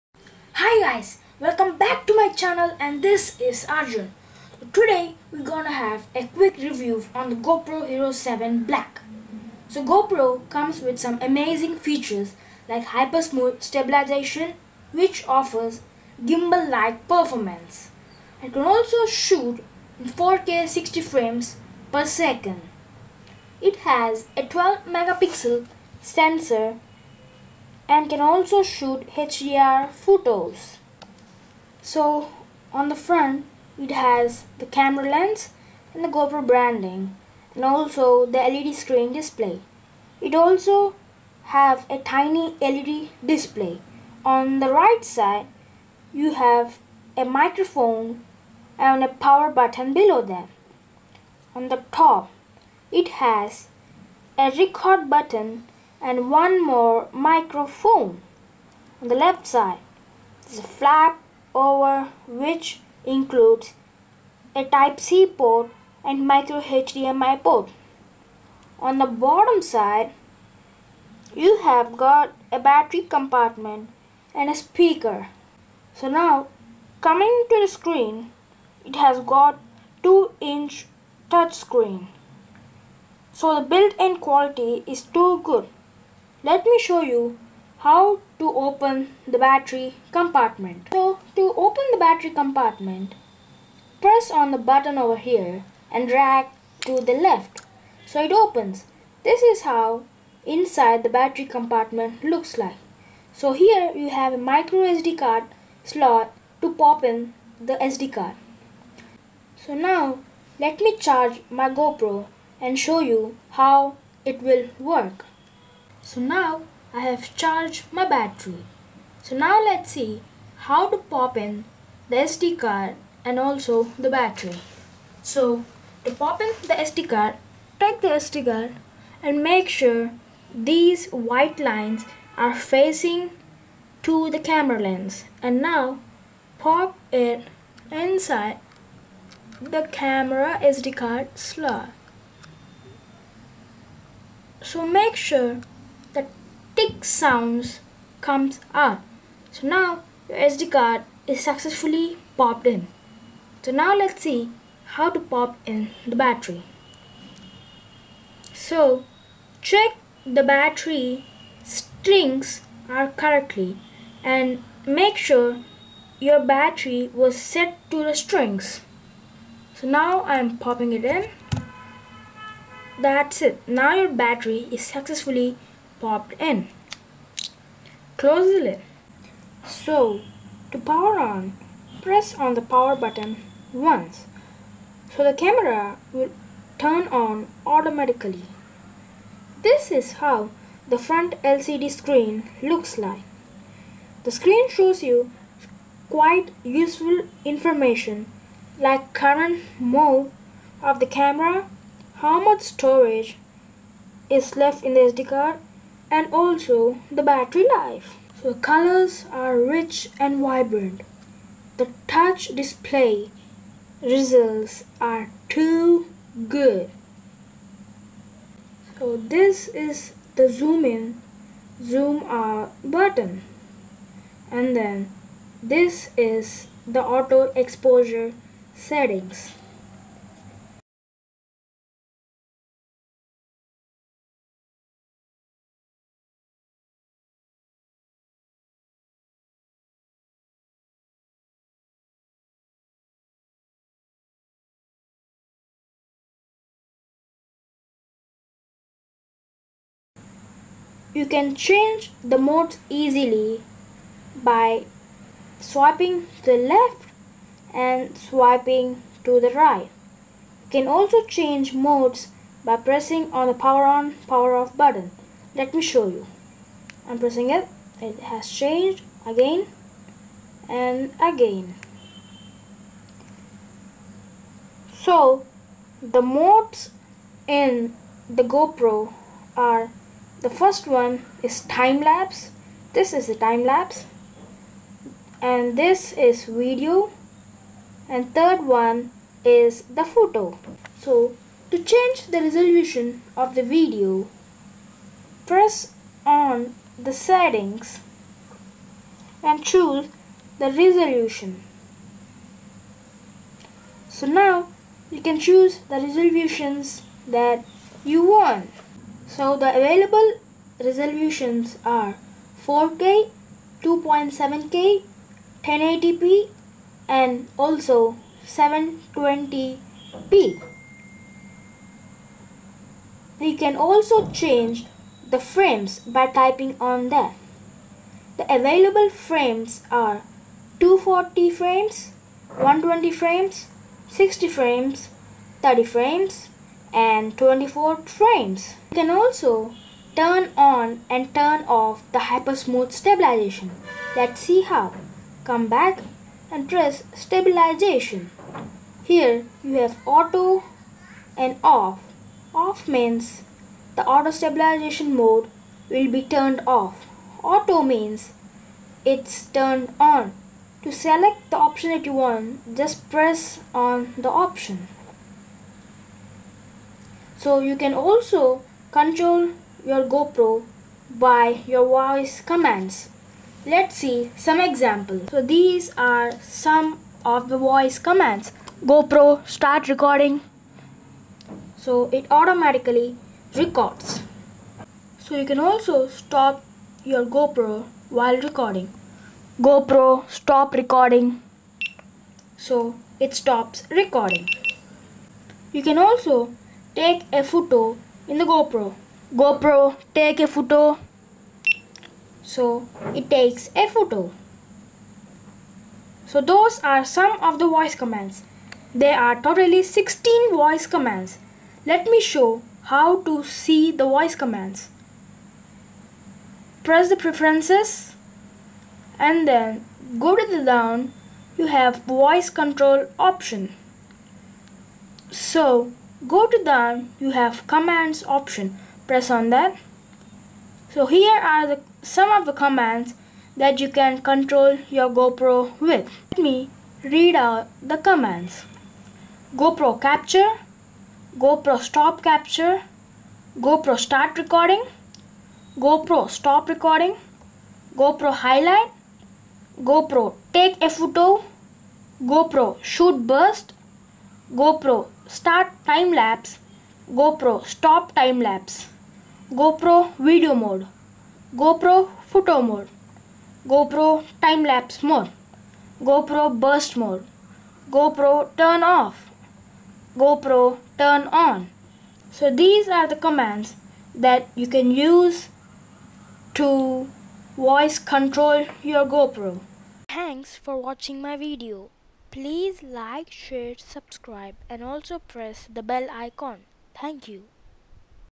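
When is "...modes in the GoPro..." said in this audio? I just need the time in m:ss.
4:36.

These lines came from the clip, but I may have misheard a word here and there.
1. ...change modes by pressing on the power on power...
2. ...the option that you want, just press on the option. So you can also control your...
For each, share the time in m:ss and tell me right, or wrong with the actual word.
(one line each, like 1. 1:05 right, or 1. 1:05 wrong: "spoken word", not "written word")
1. 4:21 right
2. 6:01 right.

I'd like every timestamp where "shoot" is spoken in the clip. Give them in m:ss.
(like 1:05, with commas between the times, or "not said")
0:19, 0:28, 7:32.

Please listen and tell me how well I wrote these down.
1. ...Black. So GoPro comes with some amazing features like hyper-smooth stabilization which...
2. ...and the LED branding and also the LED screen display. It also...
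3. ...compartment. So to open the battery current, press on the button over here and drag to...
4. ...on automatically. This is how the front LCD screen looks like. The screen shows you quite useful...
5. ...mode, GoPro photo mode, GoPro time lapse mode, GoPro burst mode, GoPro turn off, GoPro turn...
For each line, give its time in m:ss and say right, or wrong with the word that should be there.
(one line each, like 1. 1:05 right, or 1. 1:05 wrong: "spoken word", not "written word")
1. 0:08 right
2. 0:35 wrong: "GoPro", not "LED"
3. 1:30 wrong: "compartment", not "current"
4. 3:07 right
5. 7:40 right.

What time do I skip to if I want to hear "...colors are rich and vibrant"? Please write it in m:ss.
3:28.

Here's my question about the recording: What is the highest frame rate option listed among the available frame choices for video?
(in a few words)
240 frames.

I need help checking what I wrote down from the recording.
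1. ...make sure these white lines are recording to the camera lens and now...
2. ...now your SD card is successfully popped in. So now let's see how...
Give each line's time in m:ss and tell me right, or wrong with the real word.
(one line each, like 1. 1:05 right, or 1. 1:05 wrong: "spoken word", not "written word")
1. 2:09 wrong: "facing", not "recording"
2. 2:29 right.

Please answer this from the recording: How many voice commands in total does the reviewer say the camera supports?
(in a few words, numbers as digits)
16.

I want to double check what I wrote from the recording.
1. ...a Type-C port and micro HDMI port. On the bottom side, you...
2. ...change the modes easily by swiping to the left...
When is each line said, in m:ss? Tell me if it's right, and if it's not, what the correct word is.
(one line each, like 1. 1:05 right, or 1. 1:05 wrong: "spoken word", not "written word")
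1. 1:04 right
2. 4:11 right.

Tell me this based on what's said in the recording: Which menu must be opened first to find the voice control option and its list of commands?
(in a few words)
preferences.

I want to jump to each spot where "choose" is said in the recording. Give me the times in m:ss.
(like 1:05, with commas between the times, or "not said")
4:59, 5:05.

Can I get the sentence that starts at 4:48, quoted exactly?
And third one is the photo.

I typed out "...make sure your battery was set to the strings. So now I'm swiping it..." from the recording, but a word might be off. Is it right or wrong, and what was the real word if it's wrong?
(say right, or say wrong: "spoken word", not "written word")
wrong: "popping", not "swiping".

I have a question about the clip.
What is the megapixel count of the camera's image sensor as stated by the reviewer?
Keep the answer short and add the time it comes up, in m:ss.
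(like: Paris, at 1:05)
12 megapixel, at 0:24.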